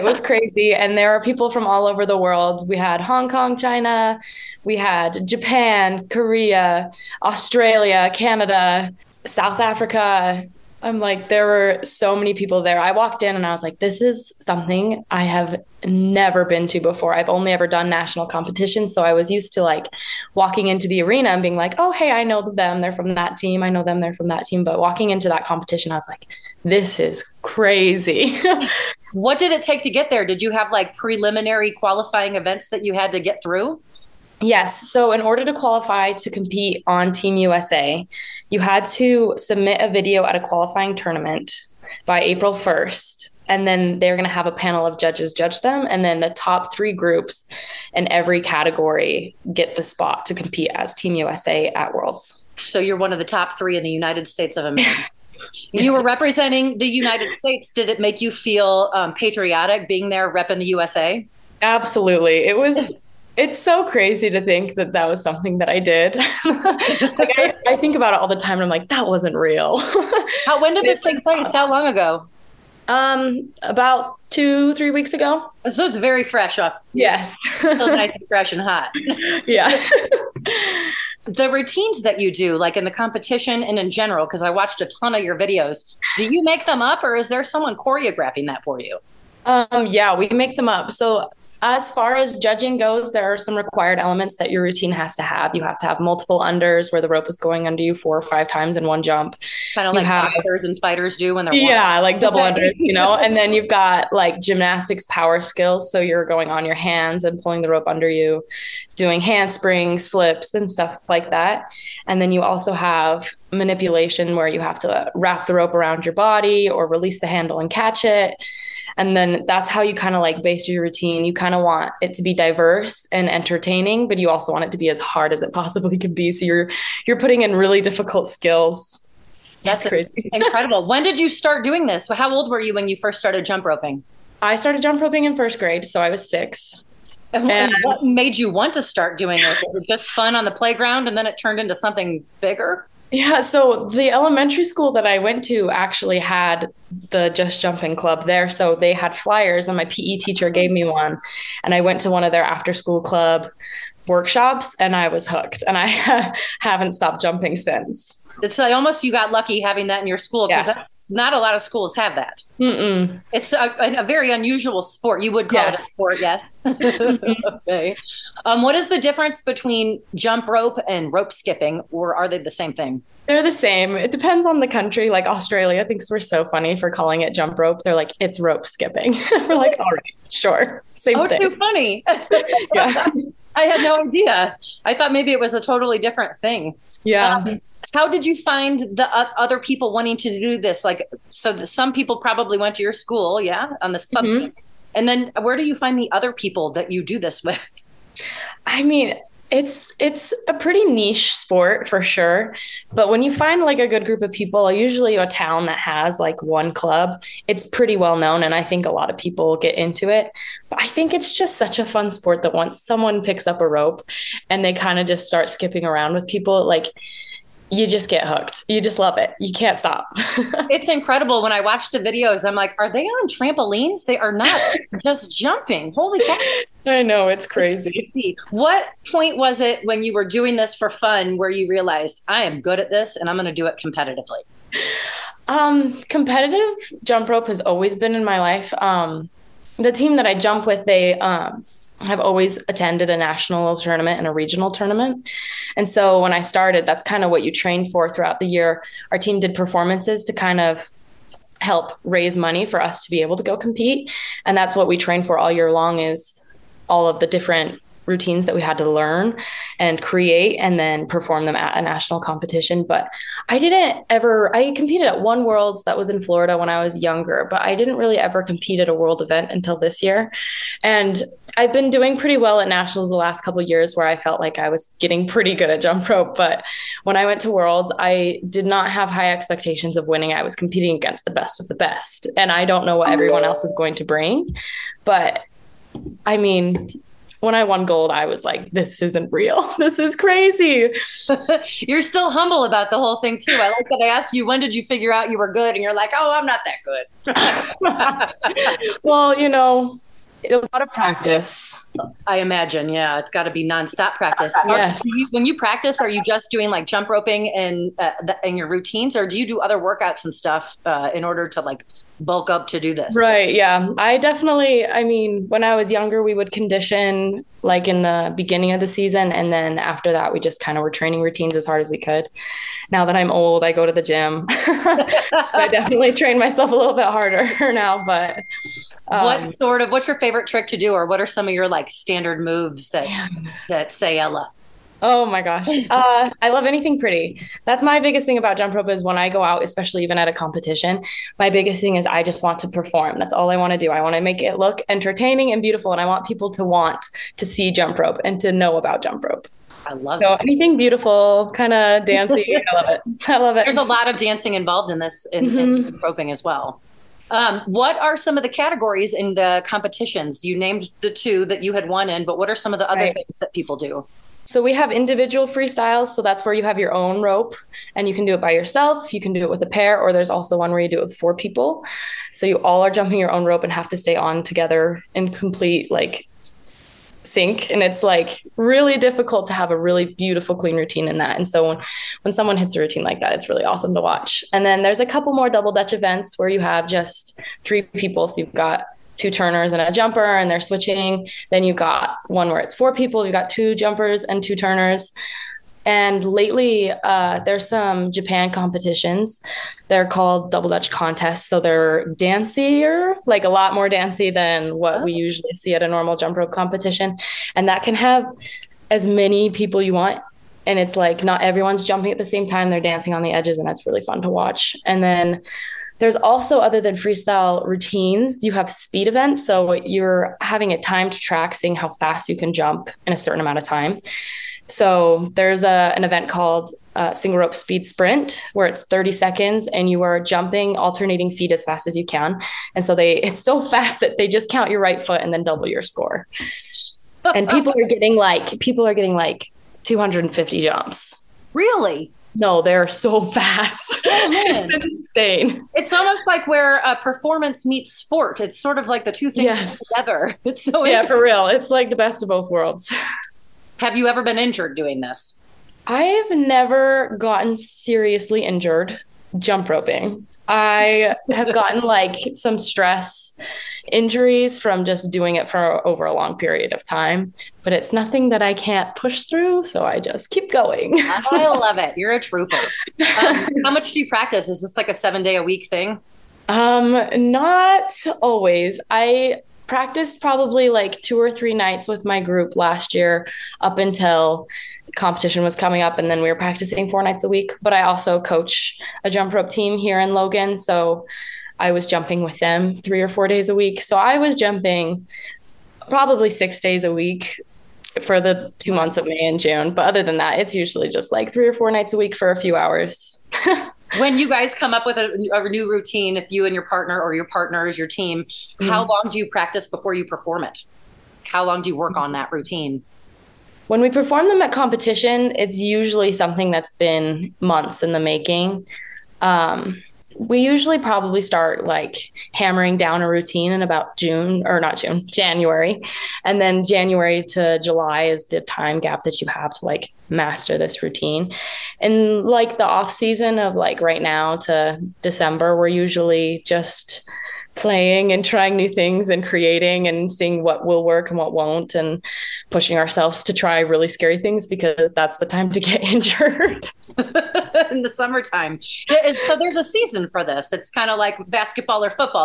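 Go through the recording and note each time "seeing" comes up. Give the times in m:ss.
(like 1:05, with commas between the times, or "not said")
7:01, 9:00.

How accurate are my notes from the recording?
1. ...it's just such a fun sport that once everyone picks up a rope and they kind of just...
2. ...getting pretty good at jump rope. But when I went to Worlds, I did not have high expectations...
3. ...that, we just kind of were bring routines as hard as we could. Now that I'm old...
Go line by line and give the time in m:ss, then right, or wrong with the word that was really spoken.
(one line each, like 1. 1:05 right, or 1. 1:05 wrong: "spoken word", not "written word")
1. 3:31 wrong: "someone", not "everyone"
2. 4:34 right
3. 5:20 wrong: "training", not "bring".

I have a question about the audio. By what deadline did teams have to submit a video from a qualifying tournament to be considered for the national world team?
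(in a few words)
April 1st.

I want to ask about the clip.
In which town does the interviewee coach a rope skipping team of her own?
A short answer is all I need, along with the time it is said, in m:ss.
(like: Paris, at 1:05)
Logan, at 8:10.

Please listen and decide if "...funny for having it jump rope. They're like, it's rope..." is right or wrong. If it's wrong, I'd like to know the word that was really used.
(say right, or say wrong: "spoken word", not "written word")
wrong: "calling", not "having".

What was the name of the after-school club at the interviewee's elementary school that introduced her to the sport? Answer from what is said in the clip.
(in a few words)
Just Jumpin Club.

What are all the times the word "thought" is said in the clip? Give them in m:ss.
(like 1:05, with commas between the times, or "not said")
3:04.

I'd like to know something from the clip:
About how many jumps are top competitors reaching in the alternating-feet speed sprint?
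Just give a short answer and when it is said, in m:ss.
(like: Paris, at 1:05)
250, at 7:19.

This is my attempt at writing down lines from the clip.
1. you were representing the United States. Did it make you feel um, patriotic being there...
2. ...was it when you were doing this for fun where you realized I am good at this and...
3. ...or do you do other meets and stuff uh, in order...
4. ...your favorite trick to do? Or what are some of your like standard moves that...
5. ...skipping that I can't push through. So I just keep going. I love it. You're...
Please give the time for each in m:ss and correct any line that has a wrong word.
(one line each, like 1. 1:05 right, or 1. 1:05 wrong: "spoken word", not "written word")
1. 0:55 right
2. 3:49 right
3. 5:09 wrong: "workouts", not "meets"
4. 5:30 right
5. 7:47 wrong: "nothing", not "skipping".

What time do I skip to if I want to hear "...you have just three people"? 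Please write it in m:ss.
6:26.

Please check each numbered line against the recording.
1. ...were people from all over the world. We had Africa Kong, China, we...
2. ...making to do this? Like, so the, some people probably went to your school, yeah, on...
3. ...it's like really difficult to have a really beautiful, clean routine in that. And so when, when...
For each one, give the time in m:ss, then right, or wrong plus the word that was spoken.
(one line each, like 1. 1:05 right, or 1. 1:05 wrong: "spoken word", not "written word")
1. 0:01 wrong: "Hong", not "Africa"
2. 3:09 wrong: "wanting", not "making"
3. 6:17 right.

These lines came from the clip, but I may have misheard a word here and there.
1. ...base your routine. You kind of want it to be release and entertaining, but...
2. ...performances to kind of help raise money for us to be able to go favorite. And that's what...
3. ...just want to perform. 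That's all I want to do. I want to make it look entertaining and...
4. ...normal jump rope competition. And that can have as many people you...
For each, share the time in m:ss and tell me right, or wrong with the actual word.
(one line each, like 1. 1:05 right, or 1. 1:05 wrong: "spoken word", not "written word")
1. 2:00 wrong: "diverse", not "release"
2. 4:09 wrong: "compete", not "favorite"
3. 5:42 right
4. 6:45 right.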